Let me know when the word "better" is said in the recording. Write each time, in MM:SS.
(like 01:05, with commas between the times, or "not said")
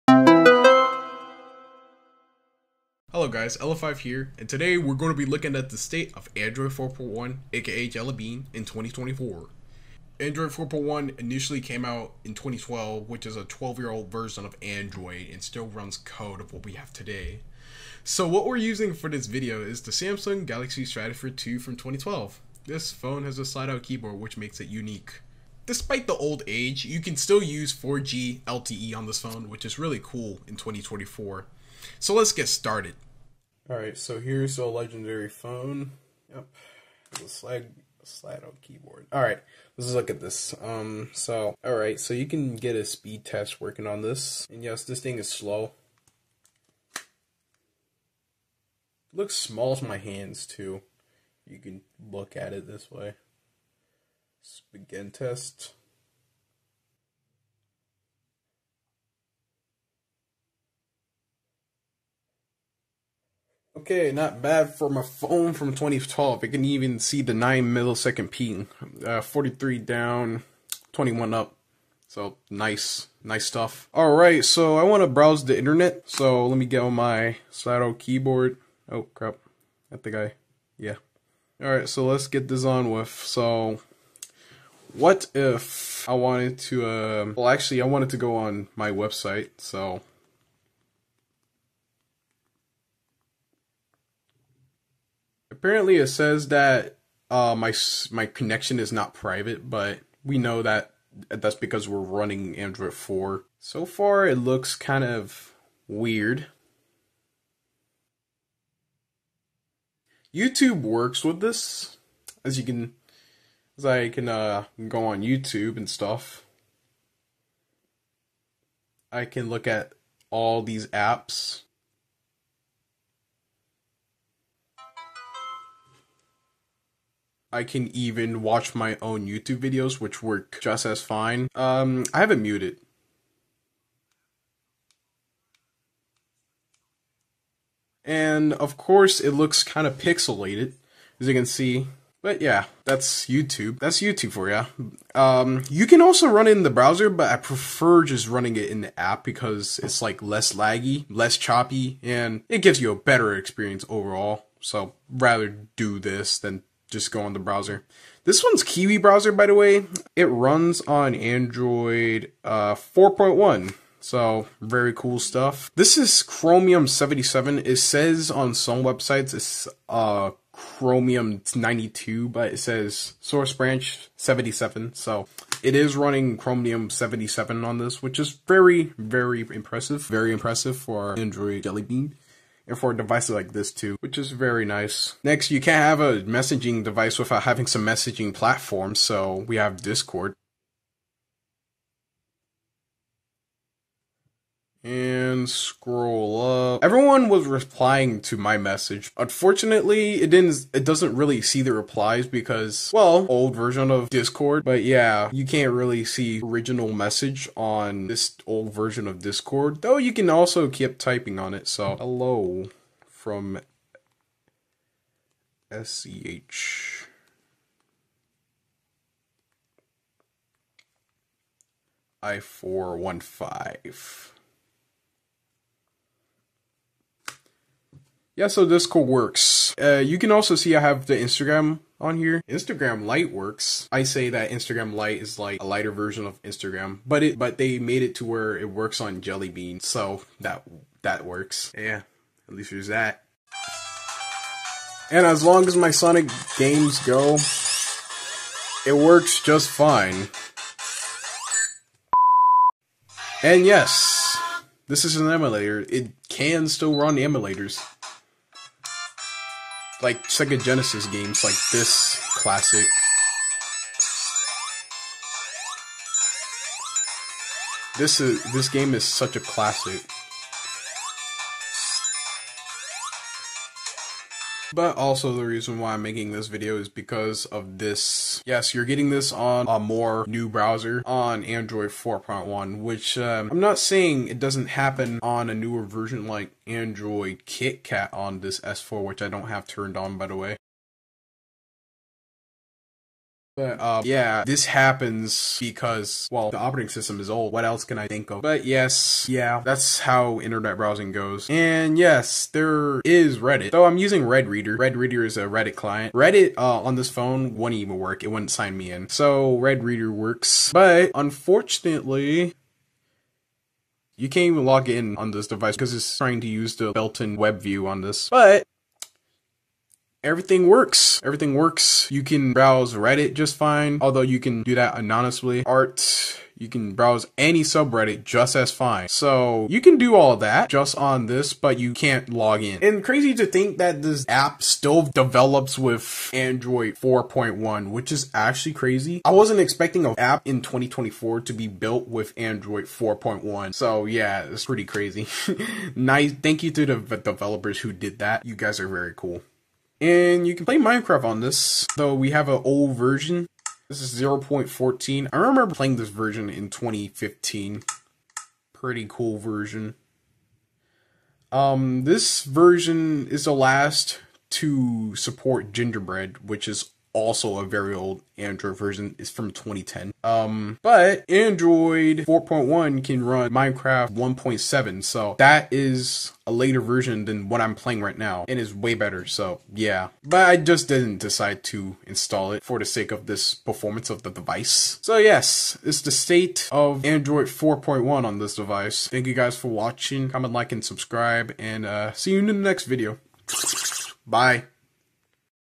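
02:32, 06:18.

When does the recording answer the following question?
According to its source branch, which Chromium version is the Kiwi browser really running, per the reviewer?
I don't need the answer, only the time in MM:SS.
02:53.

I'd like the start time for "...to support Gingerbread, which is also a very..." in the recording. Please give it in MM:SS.
06:04.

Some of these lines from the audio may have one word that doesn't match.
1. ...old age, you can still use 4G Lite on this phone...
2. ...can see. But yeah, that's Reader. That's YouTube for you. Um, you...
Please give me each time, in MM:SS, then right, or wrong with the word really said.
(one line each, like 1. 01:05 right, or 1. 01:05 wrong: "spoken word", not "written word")
1. 00:26 wrong: "LTE", not "Lite"
2. 02:21 wrong: "YouTube", not "Reader".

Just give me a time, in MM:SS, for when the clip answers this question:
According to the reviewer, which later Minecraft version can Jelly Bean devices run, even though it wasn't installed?
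06:13.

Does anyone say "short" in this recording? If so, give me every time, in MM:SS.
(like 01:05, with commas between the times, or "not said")
not said.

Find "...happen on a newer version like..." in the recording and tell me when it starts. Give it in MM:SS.
04:44.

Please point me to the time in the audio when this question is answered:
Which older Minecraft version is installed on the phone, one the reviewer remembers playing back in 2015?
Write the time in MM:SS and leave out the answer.
05:54.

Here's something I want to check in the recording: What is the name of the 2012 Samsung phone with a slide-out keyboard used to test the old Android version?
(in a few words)
Galaxy Stratosphere 2.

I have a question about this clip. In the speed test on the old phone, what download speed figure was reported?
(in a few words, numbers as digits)
43.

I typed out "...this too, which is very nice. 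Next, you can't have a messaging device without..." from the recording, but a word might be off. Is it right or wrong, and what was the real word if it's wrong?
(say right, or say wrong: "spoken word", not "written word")
right.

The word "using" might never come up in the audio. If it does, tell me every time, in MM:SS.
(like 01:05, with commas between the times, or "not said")
00:18, 05:03.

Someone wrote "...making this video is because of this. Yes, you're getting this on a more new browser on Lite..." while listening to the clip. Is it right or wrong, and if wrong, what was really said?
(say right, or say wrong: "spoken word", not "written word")
wrong: "Android", not "Lite".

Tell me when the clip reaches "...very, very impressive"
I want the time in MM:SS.
02:58.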